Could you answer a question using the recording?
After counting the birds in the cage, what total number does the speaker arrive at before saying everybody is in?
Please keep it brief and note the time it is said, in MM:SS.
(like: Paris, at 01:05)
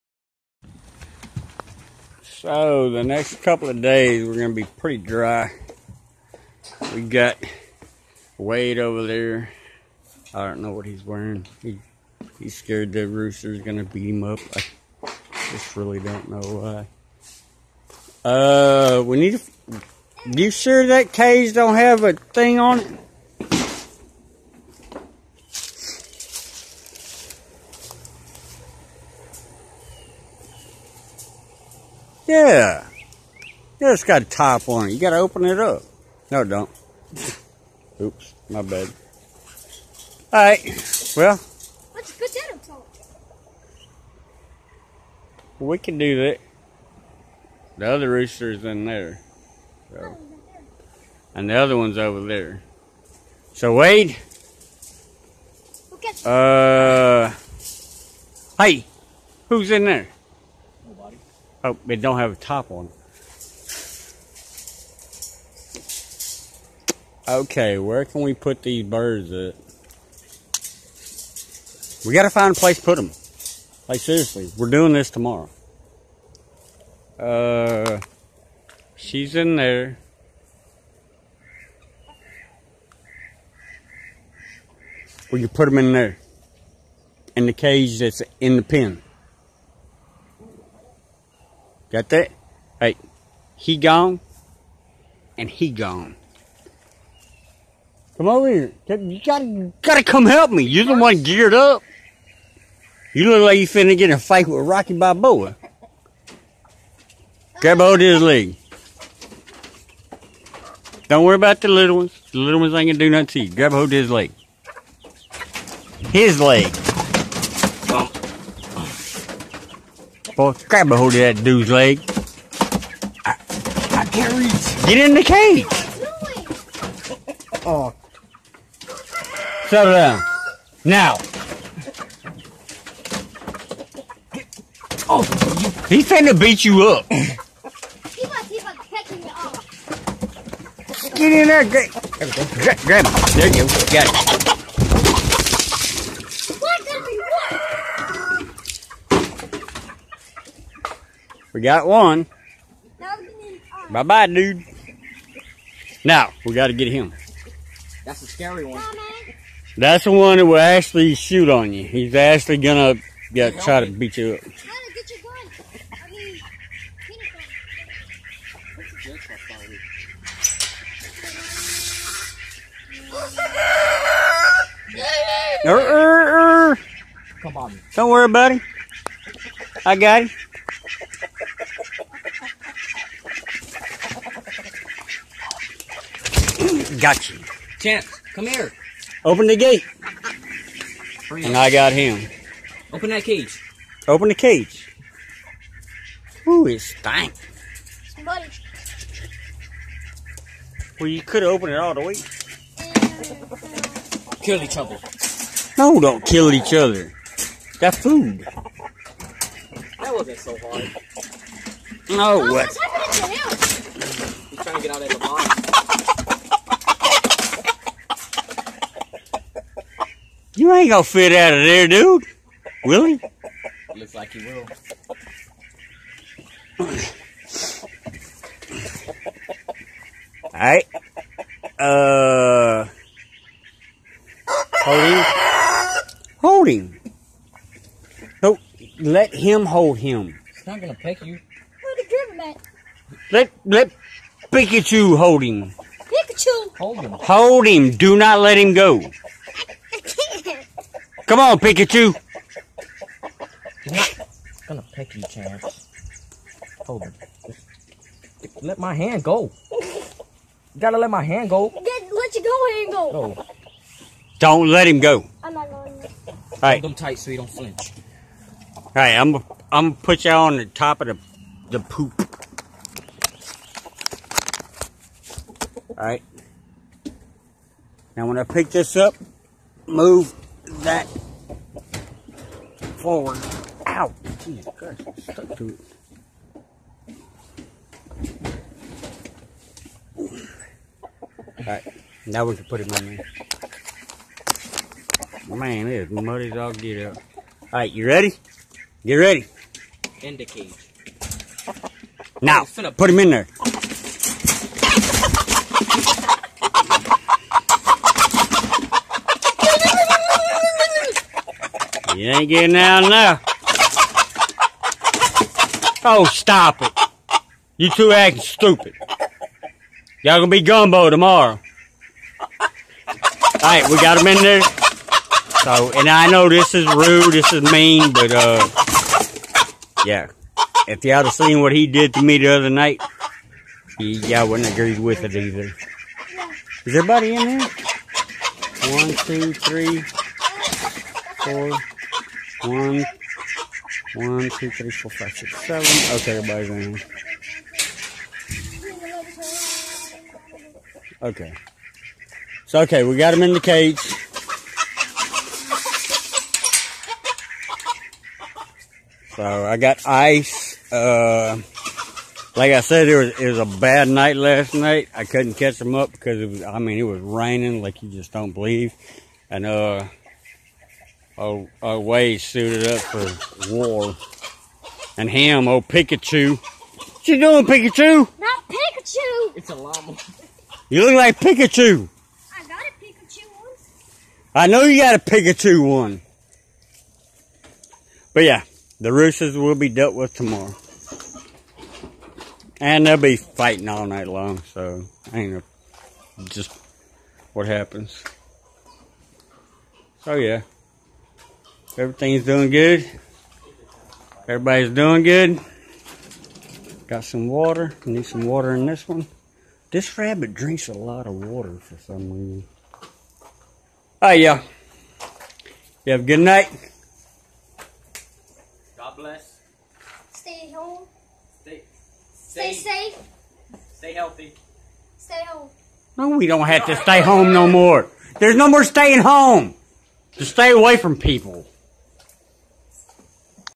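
7, at 05:45.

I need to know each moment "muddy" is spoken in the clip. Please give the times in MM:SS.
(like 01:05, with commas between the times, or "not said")
04:56.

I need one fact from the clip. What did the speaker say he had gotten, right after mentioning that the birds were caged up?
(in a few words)
Ice.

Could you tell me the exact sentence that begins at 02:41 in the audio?
He's actually going to yeah, try to beat you up.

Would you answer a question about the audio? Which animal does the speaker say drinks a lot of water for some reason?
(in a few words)
Rabbit.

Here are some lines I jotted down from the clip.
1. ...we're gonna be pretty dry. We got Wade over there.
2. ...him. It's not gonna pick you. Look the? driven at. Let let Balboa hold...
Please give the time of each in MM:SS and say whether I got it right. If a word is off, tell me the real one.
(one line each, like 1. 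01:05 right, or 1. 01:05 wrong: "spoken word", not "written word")
1. 00:04 right
2. 03:59 wrong: "Pikachu", not "Balboa".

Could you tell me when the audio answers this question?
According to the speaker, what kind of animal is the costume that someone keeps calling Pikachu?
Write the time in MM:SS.
06:19.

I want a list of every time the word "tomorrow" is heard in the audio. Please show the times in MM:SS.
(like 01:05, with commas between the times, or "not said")
01:15, 05:21, 06:30.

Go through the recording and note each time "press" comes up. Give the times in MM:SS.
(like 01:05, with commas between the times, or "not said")
not said.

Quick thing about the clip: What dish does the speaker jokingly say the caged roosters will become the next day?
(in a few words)
Gumbo.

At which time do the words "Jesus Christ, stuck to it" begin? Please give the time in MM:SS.
04:44.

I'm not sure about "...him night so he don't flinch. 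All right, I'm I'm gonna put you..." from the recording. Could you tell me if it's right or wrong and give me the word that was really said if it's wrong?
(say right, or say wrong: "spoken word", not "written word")
wrong: "tight", not "night".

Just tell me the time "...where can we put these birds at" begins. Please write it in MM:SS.
01:07.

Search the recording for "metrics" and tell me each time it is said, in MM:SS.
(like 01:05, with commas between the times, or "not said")
not said.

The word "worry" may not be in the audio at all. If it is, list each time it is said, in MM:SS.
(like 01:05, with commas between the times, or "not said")
01:51, 02:58.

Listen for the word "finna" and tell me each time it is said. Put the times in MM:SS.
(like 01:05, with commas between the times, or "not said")
01:43, 02:16.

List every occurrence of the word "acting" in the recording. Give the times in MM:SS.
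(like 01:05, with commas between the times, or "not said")
05:18.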